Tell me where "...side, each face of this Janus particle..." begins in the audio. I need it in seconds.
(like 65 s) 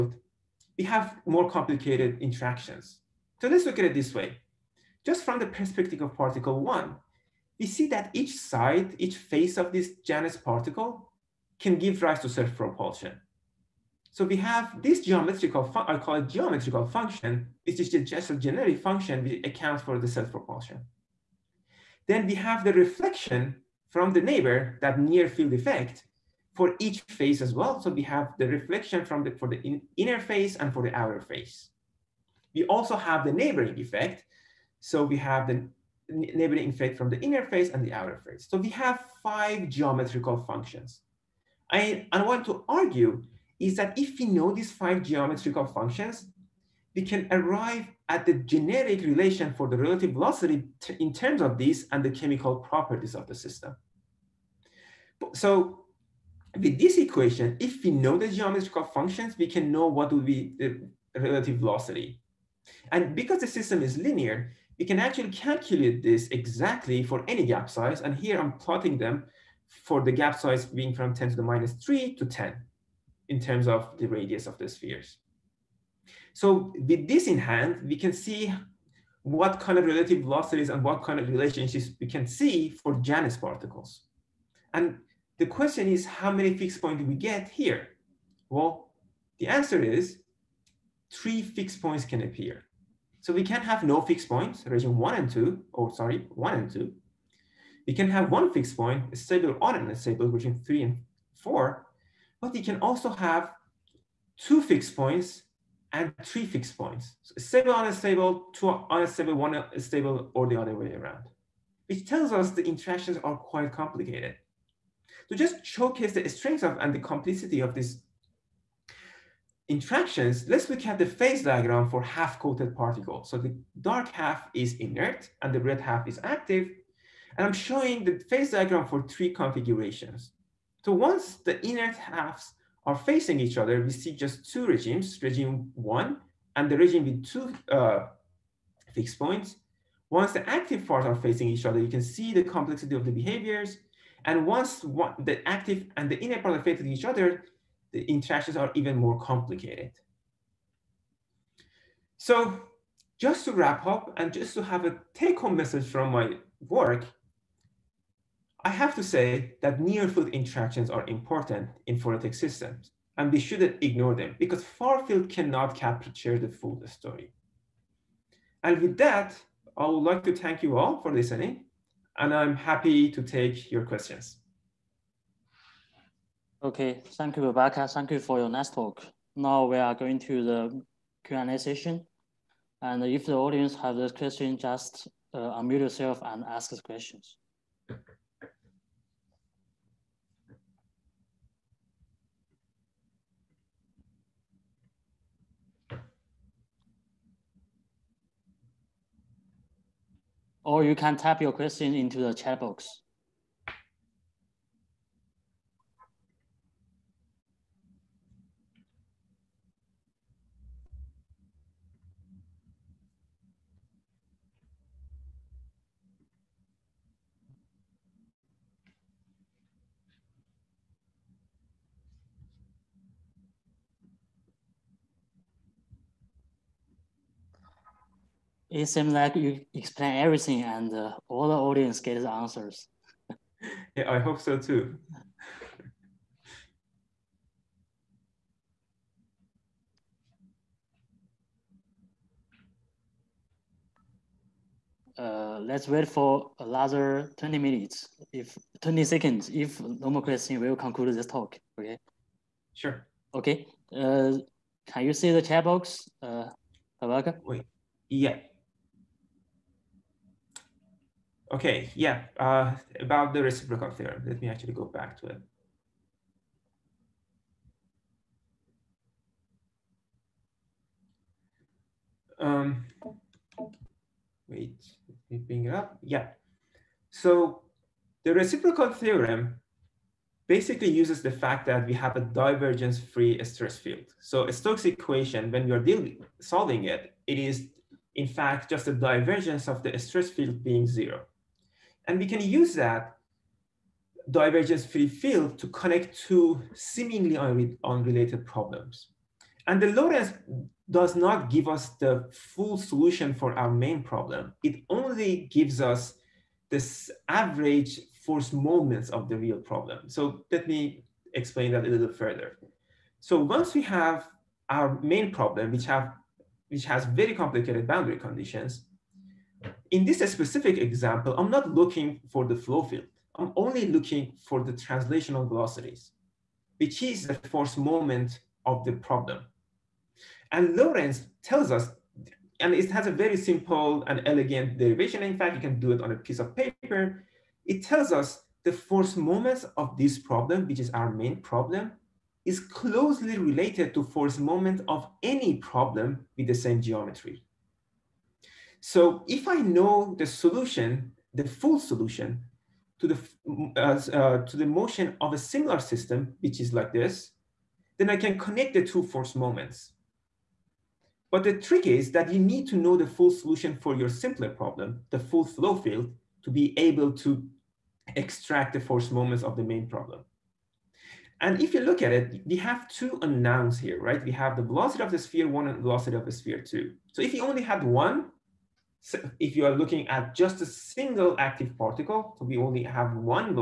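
8 s.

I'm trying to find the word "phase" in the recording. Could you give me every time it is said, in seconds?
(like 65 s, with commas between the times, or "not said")
121 s, 128 s.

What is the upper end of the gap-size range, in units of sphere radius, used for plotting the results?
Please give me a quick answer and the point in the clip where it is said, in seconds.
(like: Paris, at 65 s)
10, at 72 s.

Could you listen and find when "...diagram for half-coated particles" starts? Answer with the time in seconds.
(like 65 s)
121 s.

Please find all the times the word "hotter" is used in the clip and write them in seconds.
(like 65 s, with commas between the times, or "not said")
not said.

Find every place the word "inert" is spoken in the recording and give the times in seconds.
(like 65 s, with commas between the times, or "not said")
124 s, 131 s.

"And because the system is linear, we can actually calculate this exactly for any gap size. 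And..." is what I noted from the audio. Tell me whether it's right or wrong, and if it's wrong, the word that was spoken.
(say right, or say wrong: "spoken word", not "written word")
right.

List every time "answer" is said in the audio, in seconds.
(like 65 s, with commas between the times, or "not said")
89 s, 232 s.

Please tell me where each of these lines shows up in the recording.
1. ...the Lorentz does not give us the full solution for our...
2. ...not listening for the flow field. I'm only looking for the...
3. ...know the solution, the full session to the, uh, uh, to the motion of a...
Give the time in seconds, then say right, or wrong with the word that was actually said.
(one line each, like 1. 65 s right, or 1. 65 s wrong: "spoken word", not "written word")
1. 299 s right
2. 321 s wrong: "looking", not "listening"
3. 349 s wrong: "solution", not "session".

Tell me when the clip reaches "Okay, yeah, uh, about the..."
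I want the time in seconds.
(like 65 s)
261 s.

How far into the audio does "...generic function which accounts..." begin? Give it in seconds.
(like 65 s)
18 s.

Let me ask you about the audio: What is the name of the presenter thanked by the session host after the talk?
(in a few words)
Rebecca.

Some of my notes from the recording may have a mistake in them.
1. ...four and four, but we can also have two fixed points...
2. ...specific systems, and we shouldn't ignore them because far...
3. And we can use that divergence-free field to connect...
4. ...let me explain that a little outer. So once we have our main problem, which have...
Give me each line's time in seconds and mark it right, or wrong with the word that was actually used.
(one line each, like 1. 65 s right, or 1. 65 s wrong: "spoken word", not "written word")
1. 100 s wrong: "three", not "four"
2. 161 s wrong: "phoretic", not "specific"
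3. 292 s right
4. 310 s wrong: "further", not "outer".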